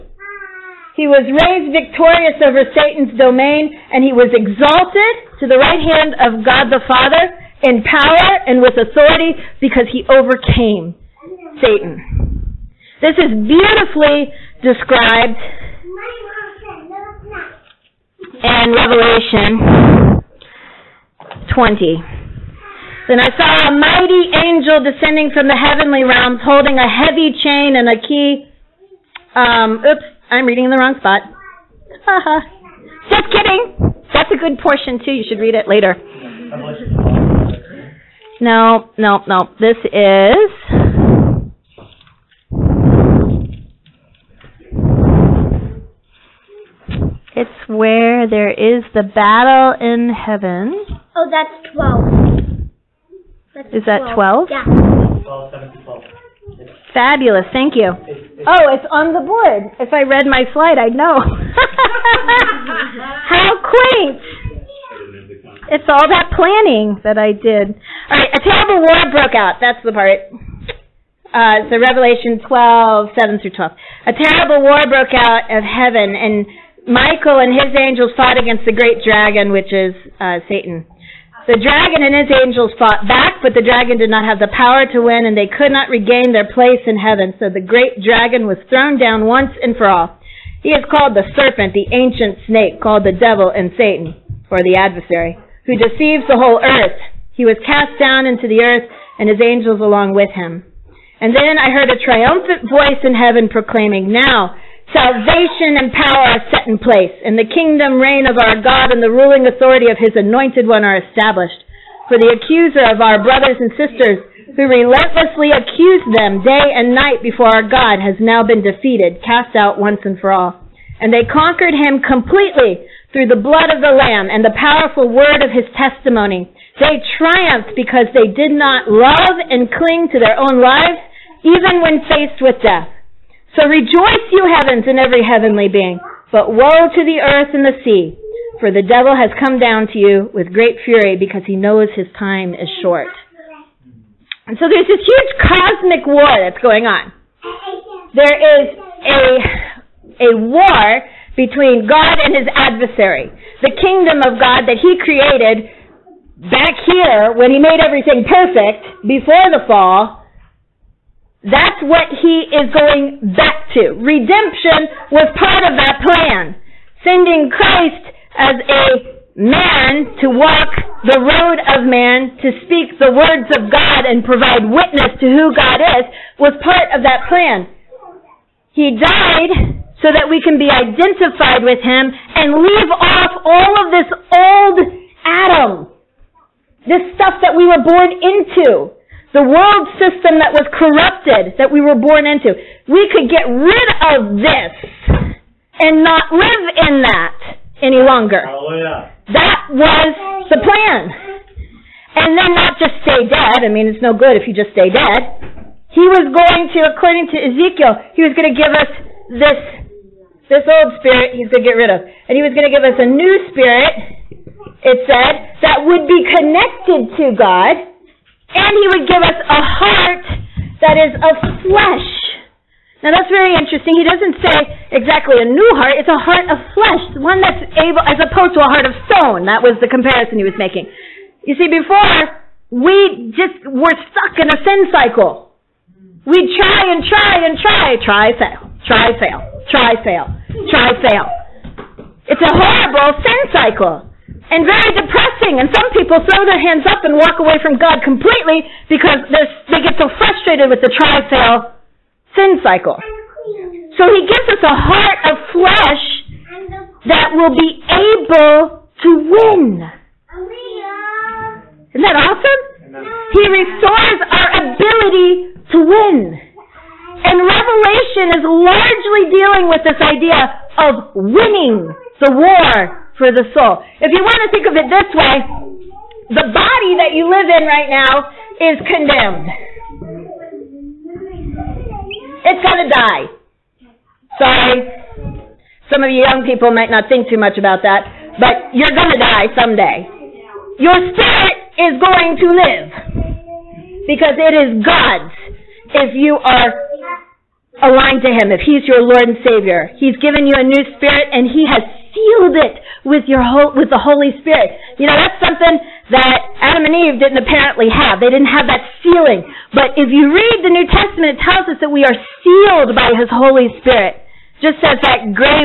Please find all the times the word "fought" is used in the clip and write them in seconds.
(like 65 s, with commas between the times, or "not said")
78 s, 82 s.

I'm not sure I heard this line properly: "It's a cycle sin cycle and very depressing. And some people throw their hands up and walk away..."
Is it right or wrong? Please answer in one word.
wrong.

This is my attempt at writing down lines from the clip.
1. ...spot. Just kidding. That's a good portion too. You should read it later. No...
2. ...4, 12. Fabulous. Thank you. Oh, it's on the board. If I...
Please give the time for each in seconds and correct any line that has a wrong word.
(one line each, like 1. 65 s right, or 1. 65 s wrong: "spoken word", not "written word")
1. 30 s right
2. 55 s wrong: "7", not "4".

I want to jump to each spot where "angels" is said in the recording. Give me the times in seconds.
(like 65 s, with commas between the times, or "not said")
24 s, 77 s, 82 s, 99 s.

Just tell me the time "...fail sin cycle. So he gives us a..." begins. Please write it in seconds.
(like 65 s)
251 s.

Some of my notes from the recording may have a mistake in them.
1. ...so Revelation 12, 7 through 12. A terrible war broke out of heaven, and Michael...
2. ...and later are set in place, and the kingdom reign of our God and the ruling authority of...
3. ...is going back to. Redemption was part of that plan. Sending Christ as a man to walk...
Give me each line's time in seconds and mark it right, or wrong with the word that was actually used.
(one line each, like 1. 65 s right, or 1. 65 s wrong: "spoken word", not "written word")
1. 71 s right
2. 105 s wrong: "power", not "later"
3. 162 s right.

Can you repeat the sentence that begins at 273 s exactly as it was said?
If you want to think of it this way, the body that you live in right now is condemned.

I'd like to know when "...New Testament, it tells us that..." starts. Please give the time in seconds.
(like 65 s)
310 s.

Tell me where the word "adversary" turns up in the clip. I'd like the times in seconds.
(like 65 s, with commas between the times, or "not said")
94 s, 152 s.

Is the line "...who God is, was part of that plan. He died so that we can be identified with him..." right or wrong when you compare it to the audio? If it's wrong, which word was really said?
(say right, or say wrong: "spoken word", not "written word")
right.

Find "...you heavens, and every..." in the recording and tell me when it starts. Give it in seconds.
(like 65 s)
134 s.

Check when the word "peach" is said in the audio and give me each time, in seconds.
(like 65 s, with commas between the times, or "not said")
not said.